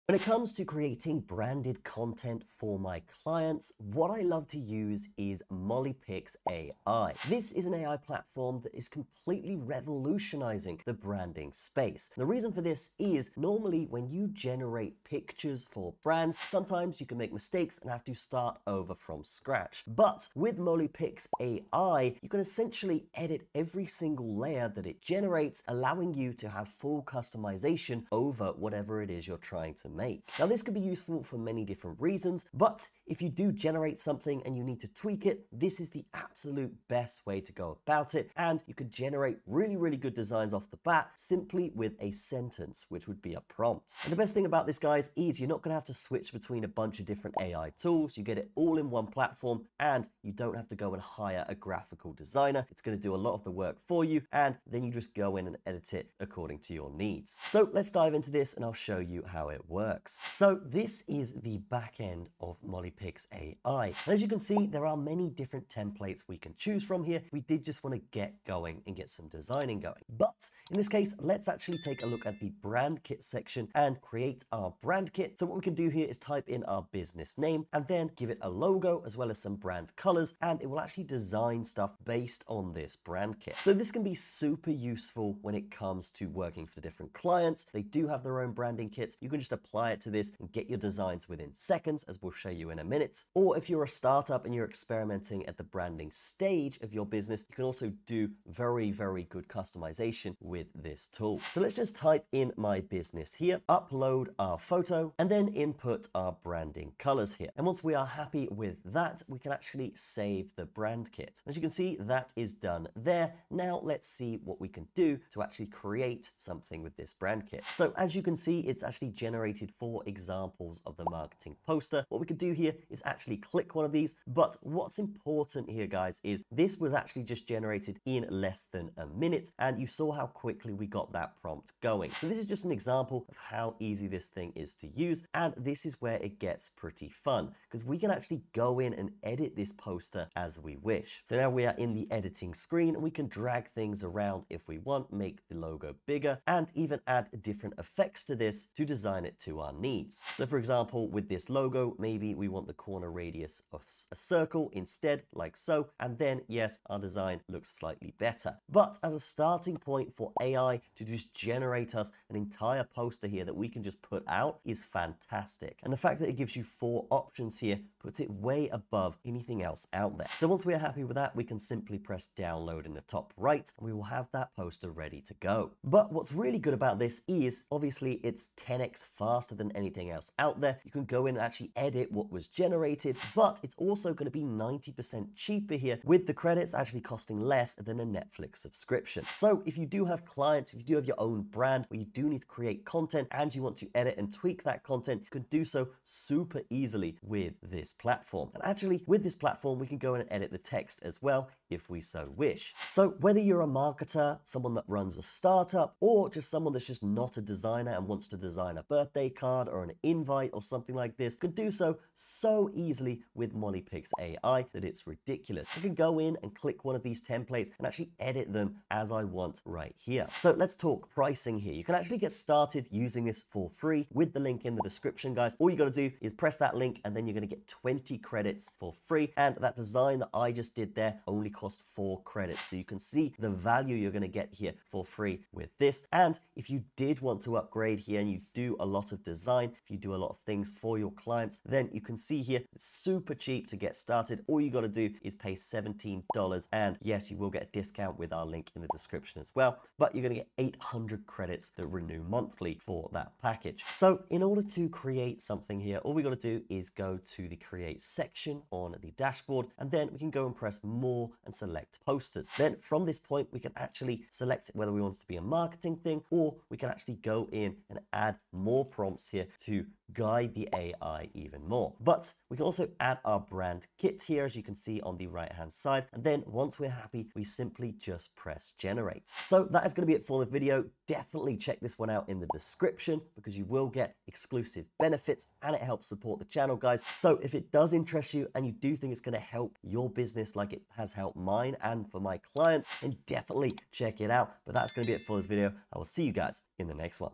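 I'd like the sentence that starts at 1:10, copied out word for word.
But in this case, let's actually take a look at the brand kit section and create our brand kit.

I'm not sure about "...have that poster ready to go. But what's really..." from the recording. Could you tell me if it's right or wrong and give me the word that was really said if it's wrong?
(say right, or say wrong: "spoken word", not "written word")
right.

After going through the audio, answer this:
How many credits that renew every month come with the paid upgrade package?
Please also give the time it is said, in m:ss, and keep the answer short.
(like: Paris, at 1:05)
800, at 4:10.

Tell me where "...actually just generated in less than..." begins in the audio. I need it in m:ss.
2:06.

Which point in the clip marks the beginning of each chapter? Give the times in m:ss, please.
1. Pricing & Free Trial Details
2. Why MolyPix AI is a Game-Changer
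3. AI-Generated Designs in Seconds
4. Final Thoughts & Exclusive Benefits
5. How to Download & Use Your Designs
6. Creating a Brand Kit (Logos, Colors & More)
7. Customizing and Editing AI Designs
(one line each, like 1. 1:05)
1. 2:50
2. 0:15
3. 1:10
4. 3:20
5. 2:20
6. 0:40
7. 1:40.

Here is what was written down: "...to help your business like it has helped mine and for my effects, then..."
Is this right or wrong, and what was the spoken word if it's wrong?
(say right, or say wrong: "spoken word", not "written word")
wrong: "clients", not "effects".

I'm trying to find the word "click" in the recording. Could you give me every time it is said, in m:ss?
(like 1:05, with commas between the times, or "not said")
2:03, 3:36.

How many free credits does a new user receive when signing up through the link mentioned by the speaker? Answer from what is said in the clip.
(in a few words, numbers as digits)
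20.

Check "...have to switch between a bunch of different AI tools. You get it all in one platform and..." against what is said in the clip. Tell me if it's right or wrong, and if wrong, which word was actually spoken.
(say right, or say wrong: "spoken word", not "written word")
right.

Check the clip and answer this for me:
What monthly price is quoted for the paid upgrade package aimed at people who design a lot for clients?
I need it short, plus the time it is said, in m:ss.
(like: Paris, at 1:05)
$17, at 4:05.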